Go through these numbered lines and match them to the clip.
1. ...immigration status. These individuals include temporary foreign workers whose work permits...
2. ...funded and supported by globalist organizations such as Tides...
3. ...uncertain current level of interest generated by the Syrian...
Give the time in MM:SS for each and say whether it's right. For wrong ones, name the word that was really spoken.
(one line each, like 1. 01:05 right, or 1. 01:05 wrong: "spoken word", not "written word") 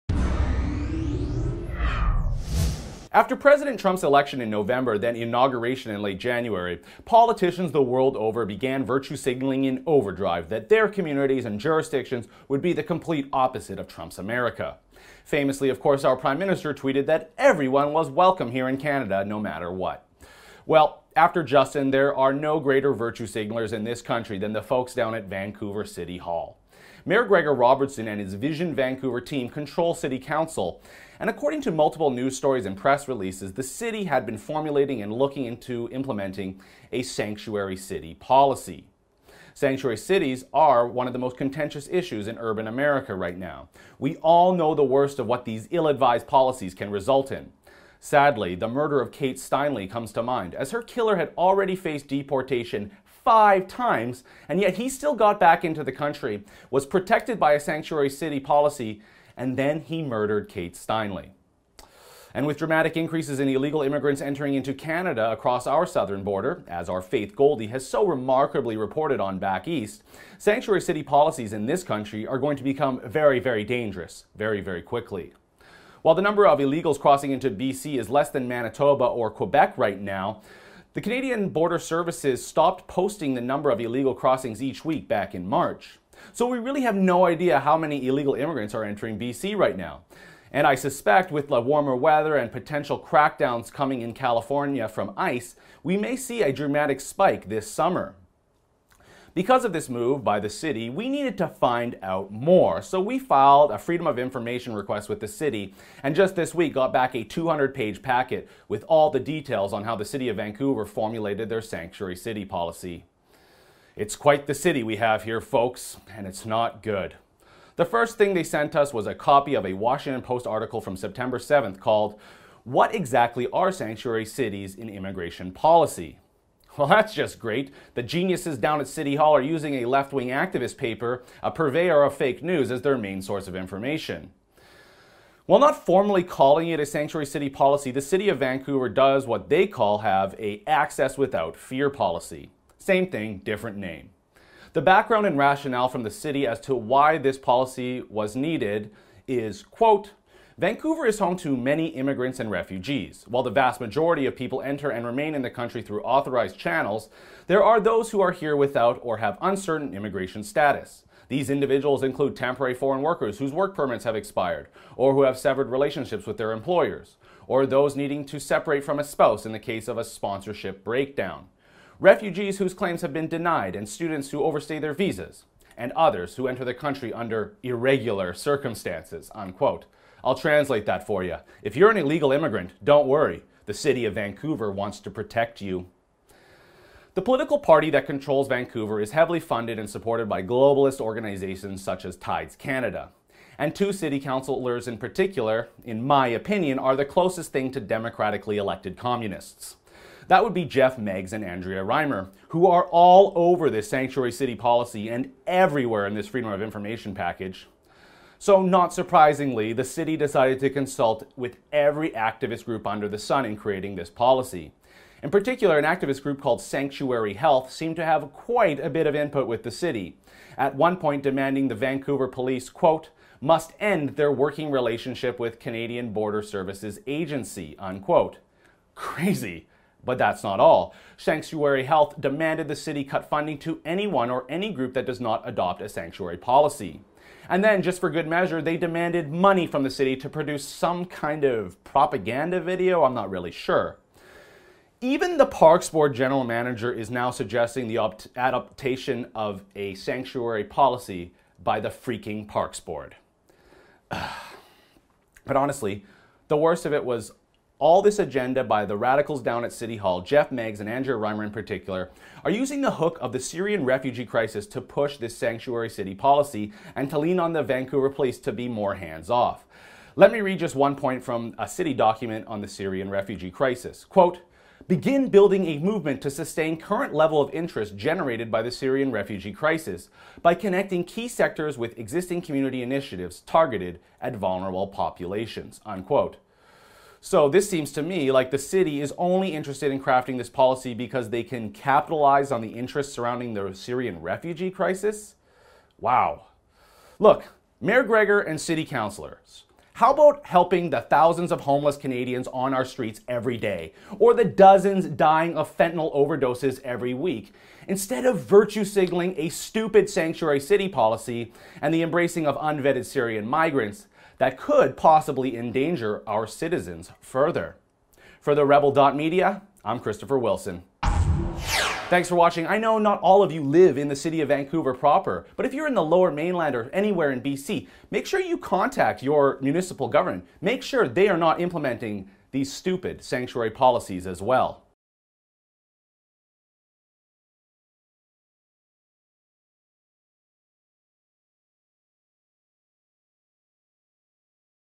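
1. 02:39 right
2. 03:09 right
3. 04:36 wrong: "sustain", not "uncertain".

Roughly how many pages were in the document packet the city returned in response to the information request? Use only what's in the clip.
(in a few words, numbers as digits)
200.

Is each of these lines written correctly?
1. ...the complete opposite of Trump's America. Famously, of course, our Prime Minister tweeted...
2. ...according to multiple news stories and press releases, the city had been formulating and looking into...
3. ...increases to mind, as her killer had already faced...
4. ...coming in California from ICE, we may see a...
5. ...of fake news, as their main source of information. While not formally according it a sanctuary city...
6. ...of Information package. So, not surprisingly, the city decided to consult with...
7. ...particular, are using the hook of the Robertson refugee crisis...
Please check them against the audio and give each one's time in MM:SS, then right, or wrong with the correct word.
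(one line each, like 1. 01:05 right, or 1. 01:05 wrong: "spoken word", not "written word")
1. 00:12 right
2. 00:31 right
3. 00:49 wrong: "comes", not "increases"
4. 01:33 right
5. 02:12 wrong: "calling", not "according"
6. 03:26 right
7. 04:21 wrong: "Syrian", not "Robertson".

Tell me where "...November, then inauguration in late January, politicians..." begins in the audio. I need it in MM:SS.
00:04.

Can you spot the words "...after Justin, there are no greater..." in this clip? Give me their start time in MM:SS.
00:21.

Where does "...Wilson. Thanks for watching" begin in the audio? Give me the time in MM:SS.
05:20.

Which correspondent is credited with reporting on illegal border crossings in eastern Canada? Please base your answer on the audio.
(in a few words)
Faith Goldy.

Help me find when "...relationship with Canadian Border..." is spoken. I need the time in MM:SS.
03:44.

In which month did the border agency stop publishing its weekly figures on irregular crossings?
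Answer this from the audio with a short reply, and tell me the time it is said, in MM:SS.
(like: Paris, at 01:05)
March, at 01:25.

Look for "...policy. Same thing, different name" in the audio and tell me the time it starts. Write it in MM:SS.
02:21.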